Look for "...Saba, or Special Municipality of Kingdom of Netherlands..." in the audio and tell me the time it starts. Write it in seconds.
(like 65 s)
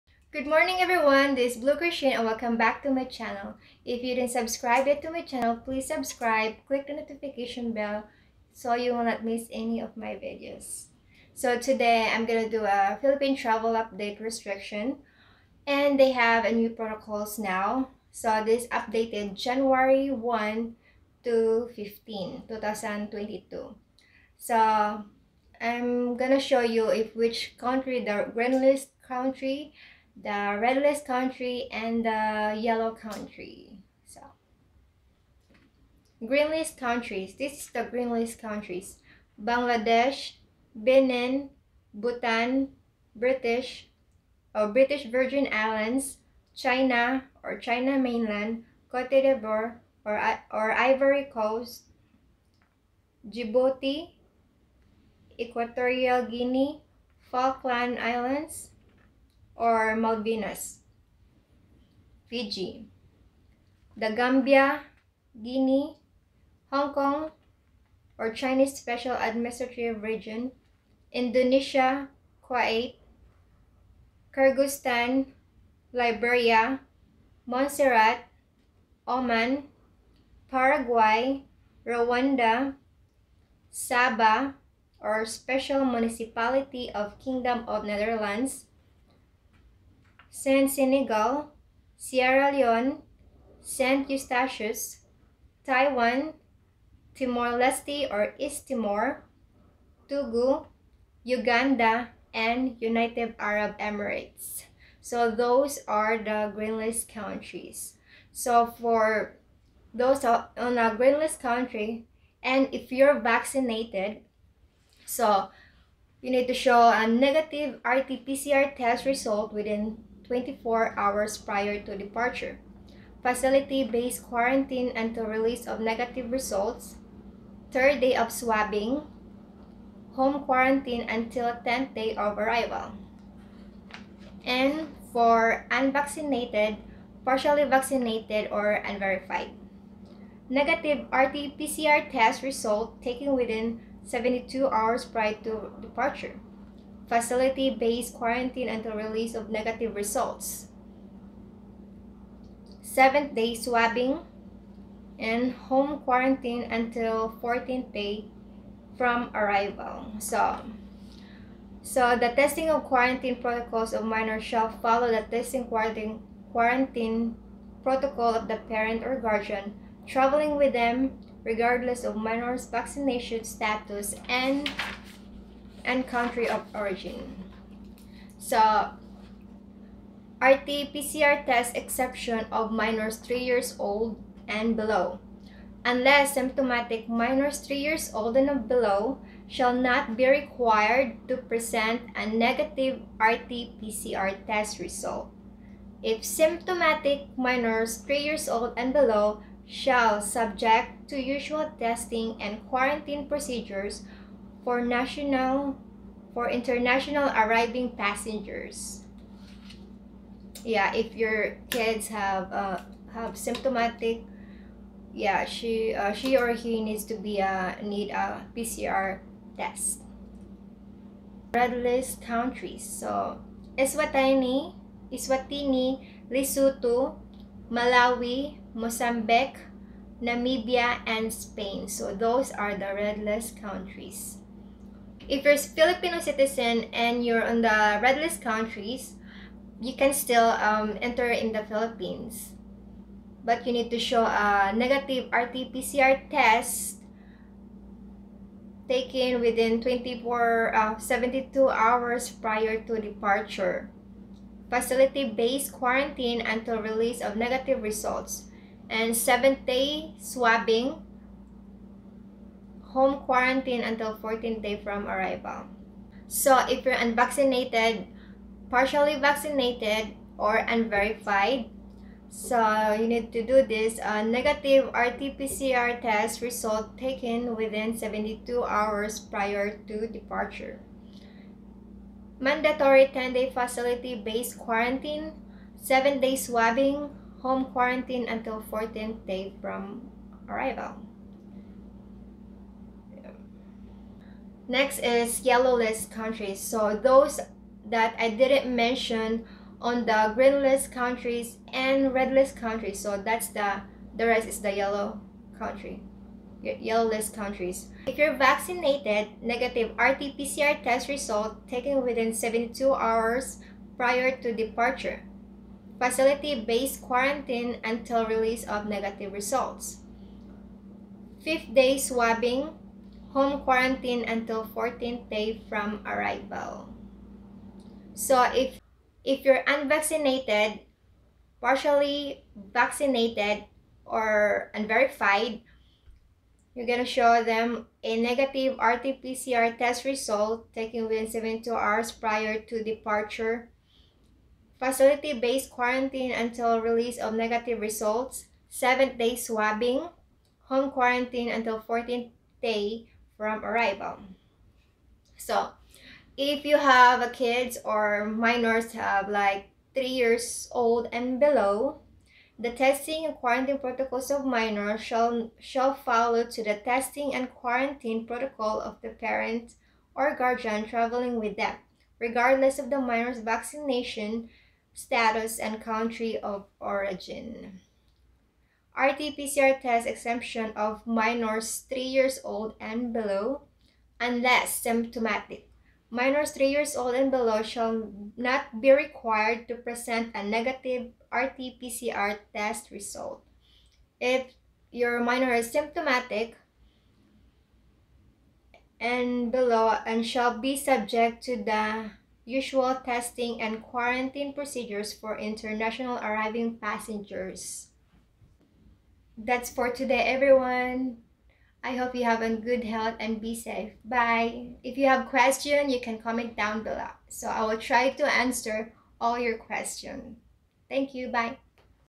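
83 s.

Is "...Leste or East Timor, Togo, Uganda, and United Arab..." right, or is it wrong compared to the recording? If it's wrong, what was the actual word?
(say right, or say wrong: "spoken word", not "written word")
right.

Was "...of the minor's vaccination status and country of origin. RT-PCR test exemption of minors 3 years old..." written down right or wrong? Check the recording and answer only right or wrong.
right.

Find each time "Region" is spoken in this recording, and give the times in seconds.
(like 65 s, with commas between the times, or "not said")
70 s.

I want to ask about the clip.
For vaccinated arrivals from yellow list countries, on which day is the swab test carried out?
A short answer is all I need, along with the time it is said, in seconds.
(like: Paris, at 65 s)
5th day, at 321 s.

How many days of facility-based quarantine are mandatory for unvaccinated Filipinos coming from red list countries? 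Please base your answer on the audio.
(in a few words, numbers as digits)
10 days.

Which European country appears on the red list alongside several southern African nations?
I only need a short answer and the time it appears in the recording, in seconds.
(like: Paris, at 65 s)
Spain, at 231 s.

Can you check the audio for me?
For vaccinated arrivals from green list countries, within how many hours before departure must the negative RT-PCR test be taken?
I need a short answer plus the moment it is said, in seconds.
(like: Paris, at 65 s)
24 hours, at 119 s.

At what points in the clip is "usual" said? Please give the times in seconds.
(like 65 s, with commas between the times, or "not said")
201 s, 402 s.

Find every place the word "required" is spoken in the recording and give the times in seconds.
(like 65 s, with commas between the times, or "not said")
190 s, 388 s.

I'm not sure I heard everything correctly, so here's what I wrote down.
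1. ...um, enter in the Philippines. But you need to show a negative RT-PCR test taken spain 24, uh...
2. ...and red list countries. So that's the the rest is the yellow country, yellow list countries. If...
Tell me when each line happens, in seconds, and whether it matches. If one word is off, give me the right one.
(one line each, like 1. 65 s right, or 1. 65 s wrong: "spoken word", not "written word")
1. 240 s wrong: "within", not "spain"
2. 301 s right.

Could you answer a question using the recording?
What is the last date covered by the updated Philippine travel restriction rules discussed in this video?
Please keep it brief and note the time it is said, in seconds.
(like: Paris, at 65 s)
January 15, 2022, at 19 s.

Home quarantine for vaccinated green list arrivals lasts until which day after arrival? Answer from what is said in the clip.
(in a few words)
10th day.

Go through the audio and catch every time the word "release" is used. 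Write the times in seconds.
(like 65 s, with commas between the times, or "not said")
125 s, 148 s, 256 s, 318 s, 346 s.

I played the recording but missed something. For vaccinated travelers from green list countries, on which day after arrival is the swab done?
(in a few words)
3rd day.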